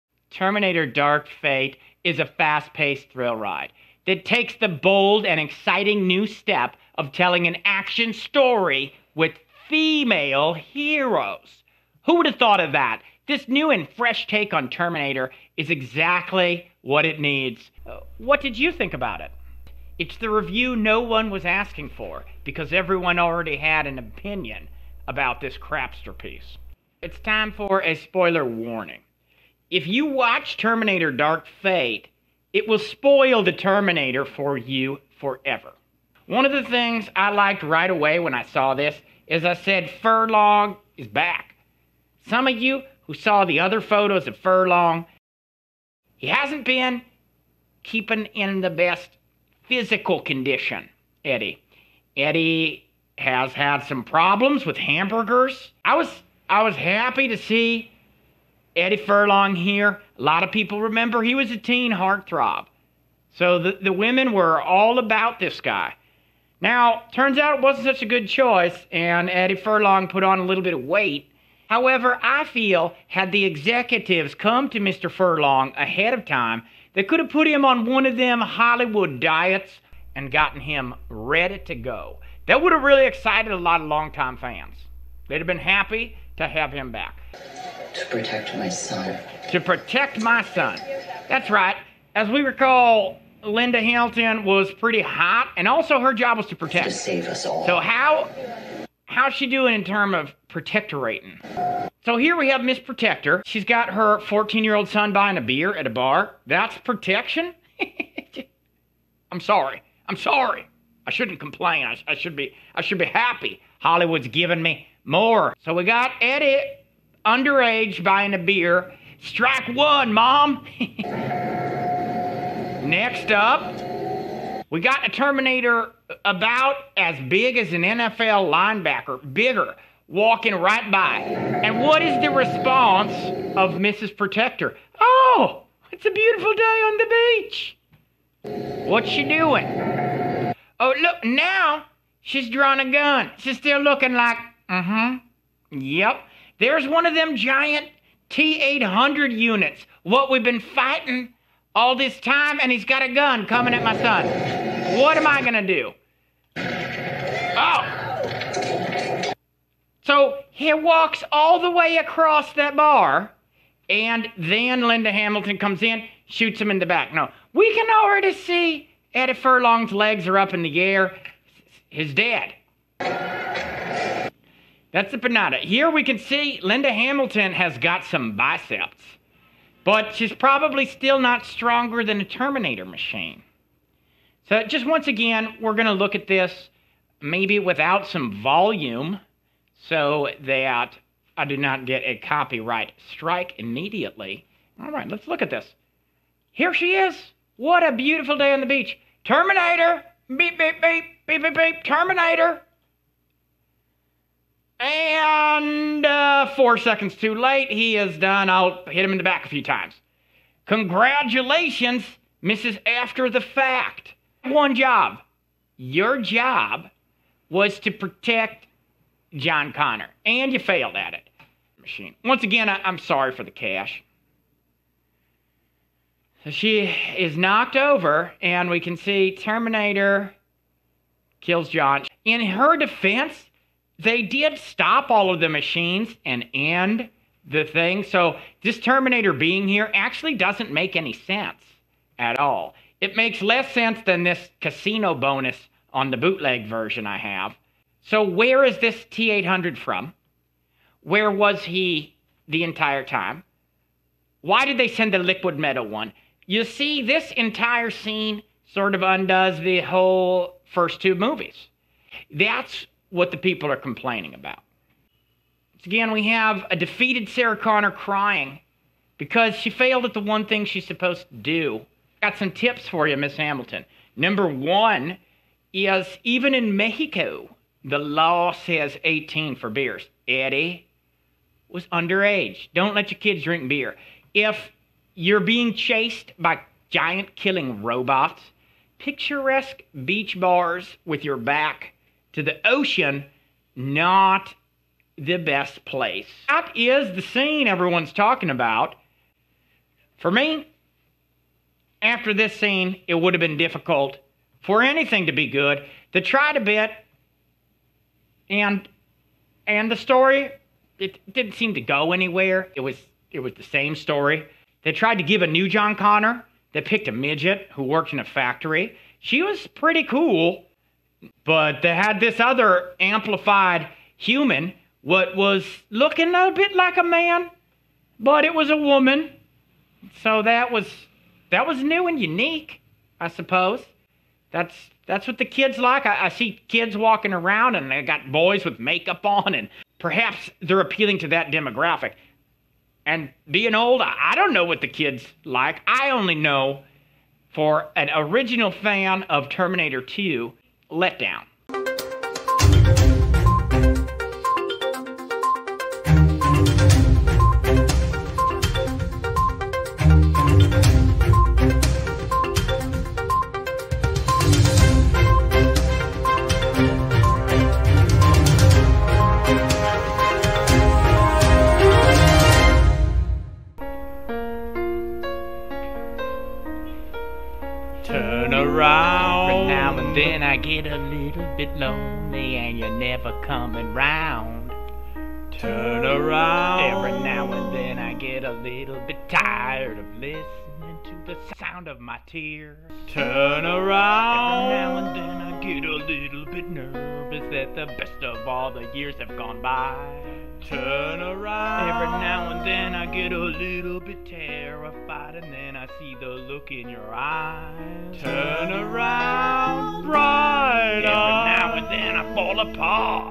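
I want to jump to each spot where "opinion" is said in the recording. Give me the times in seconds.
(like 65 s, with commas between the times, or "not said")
23 s.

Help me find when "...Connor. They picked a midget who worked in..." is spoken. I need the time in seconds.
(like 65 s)
315 s.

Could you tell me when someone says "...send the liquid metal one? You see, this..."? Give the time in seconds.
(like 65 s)
254 s.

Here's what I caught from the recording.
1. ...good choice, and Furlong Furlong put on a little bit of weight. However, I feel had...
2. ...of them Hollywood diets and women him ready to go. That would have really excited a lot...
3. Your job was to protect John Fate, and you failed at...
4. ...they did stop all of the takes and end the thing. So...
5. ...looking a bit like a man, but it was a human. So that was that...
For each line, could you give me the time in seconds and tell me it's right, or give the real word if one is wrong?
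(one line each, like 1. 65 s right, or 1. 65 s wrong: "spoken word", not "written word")
1. 68 s wrong: "Eddie", not "Furlong"
2. 78 s wrong: "gotten", not "women"
3. 215 s wrong: "Connor", not "Fate"
4. 234 s wrong: "machines", not "takes"
5. 325 s wrong: "woman", not "human".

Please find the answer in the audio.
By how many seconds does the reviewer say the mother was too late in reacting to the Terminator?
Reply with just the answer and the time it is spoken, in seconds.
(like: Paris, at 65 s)
4, at 206 s.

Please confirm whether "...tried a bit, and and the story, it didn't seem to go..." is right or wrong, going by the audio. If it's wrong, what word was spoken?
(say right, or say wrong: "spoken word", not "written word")
right.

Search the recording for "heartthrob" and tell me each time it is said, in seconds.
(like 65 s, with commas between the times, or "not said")
61 s.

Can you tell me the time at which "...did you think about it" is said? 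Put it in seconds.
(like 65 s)
18 s.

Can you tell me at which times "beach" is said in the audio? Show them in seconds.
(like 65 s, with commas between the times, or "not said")
137 s, 198 s, 290 s.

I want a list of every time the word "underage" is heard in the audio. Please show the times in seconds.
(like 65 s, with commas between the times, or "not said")
117 s, 281 s.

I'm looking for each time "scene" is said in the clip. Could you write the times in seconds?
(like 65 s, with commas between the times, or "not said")
257 s, 297 s, 302 s.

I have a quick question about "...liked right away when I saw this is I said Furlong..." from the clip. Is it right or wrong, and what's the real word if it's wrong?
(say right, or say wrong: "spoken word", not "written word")
right.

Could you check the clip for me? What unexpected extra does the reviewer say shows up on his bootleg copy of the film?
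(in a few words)
Casino bonus.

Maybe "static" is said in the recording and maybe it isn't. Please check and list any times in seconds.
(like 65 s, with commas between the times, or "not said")
not said.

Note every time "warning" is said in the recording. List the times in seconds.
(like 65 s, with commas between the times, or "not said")
28 s.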